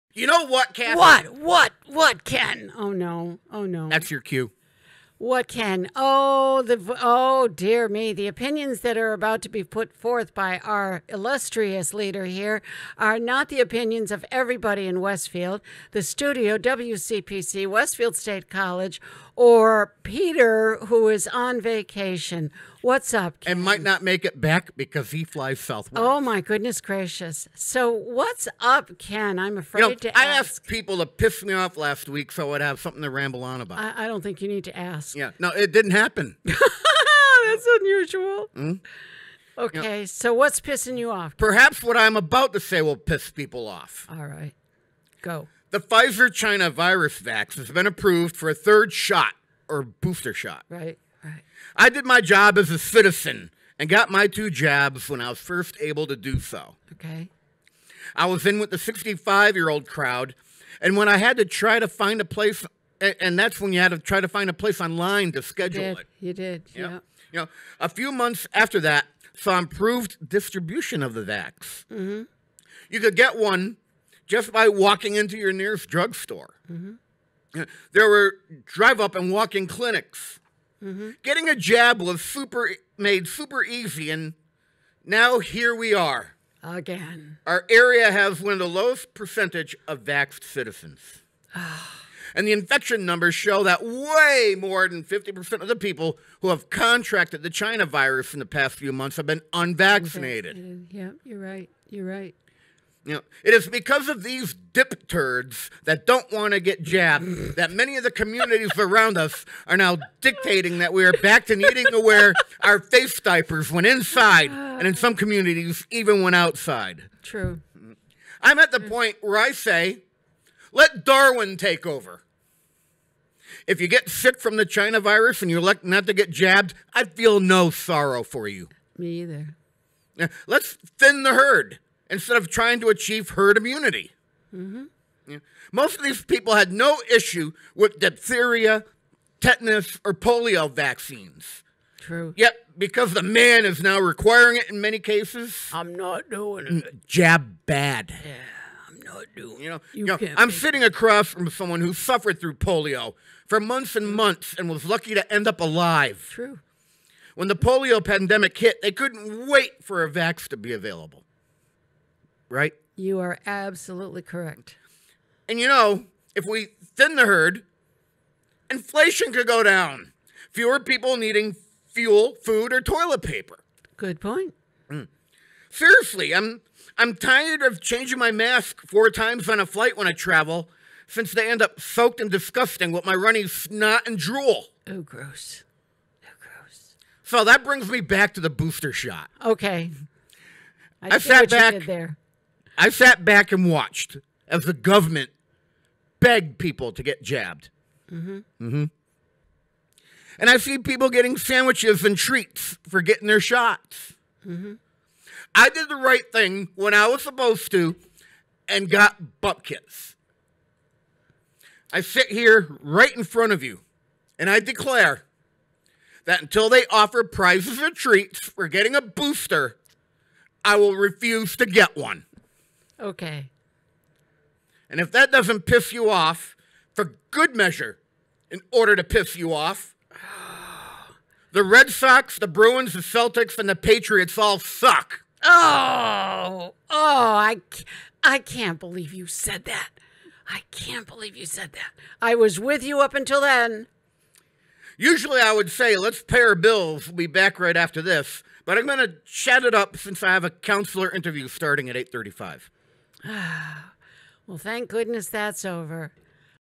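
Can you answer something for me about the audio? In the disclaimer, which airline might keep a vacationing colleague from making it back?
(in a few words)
Southwest.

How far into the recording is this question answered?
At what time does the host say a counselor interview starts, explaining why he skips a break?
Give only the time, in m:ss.
4:11.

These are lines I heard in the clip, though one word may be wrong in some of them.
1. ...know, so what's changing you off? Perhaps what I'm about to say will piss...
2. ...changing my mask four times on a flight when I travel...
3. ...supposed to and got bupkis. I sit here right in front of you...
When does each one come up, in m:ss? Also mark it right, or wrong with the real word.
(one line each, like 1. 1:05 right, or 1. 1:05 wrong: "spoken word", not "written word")
1. 0:39 wrong: "pissing", not "changing"
2. 2:57 right
3. 3:27 right.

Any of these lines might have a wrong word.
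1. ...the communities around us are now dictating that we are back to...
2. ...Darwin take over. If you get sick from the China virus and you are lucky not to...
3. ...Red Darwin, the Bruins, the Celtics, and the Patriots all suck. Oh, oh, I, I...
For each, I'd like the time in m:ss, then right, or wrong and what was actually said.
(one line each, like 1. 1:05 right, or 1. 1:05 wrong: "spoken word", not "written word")
1. 1:48 right
2. 2:01 right
3. 3:51 wrong: "Sox", not "Darwin".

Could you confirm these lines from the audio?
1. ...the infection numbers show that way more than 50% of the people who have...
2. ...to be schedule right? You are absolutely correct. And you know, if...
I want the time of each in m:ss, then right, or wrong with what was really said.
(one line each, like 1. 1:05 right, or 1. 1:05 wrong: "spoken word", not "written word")
1. 1:32 right
2. 2:40 wrong: "available", not "schedule".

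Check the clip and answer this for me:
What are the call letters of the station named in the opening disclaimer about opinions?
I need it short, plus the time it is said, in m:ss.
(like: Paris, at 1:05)
WCPC, at 0:16.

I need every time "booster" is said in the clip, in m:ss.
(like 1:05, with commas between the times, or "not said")
0:49, 3:08, 3:39.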